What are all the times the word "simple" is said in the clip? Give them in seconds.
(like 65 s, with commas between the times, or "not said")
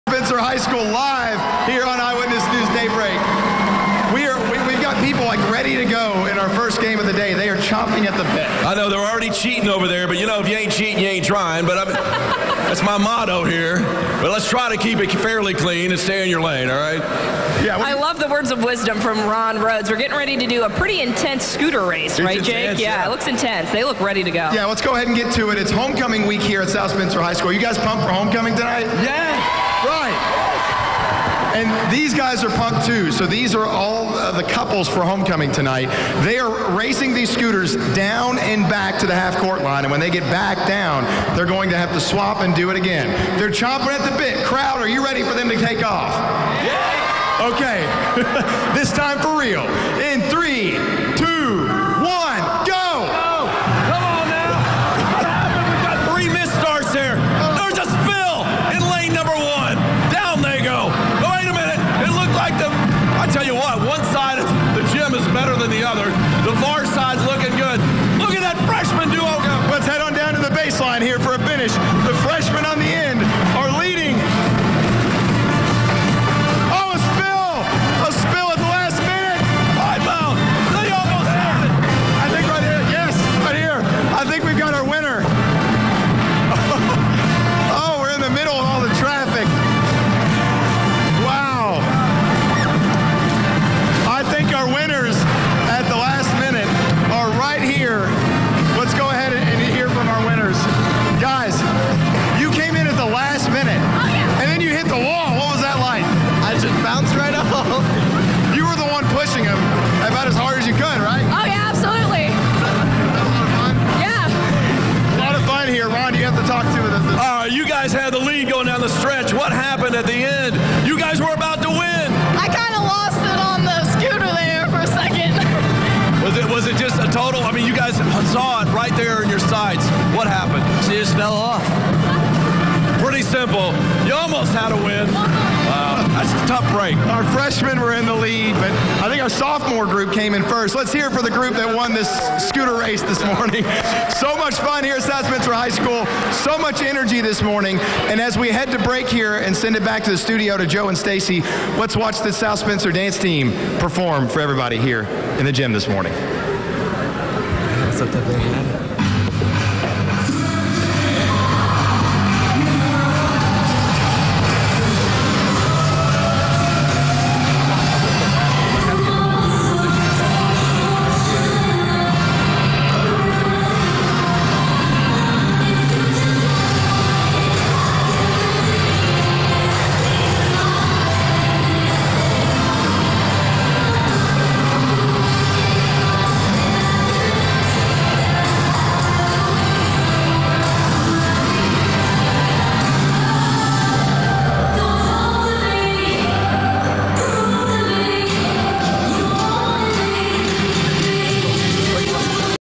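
133 s.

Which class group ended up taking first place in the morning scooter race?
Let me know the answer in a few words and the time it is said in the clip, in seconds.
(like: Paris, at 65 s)
sophomore, at 139 s.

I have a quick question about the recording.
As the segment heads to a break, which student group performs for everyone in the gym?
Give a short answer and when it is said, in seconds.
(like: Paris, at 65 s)
dance team, at 152 s.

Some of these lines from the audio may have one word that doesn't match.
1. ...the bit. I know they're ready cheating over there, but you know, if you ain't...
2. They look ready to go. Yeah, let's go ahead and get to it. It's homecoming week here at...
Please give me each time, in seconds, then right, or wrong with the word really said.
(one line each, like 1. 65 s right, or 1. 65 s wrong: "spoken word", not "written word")
1. 8 s wrong: "already", not "ready"
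2. 23 s right.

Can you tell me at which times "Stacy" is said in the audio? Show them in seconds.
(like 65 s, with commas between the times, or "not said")
150 s.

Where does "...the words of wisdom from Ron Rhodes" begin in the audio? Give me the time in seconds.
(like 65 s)
18 s.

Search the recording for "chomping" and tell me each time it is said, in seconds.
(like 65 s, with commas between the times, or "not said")
7 s, 43 s.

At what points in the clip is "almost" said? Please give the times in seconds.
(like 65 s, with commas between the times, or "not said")
134 s.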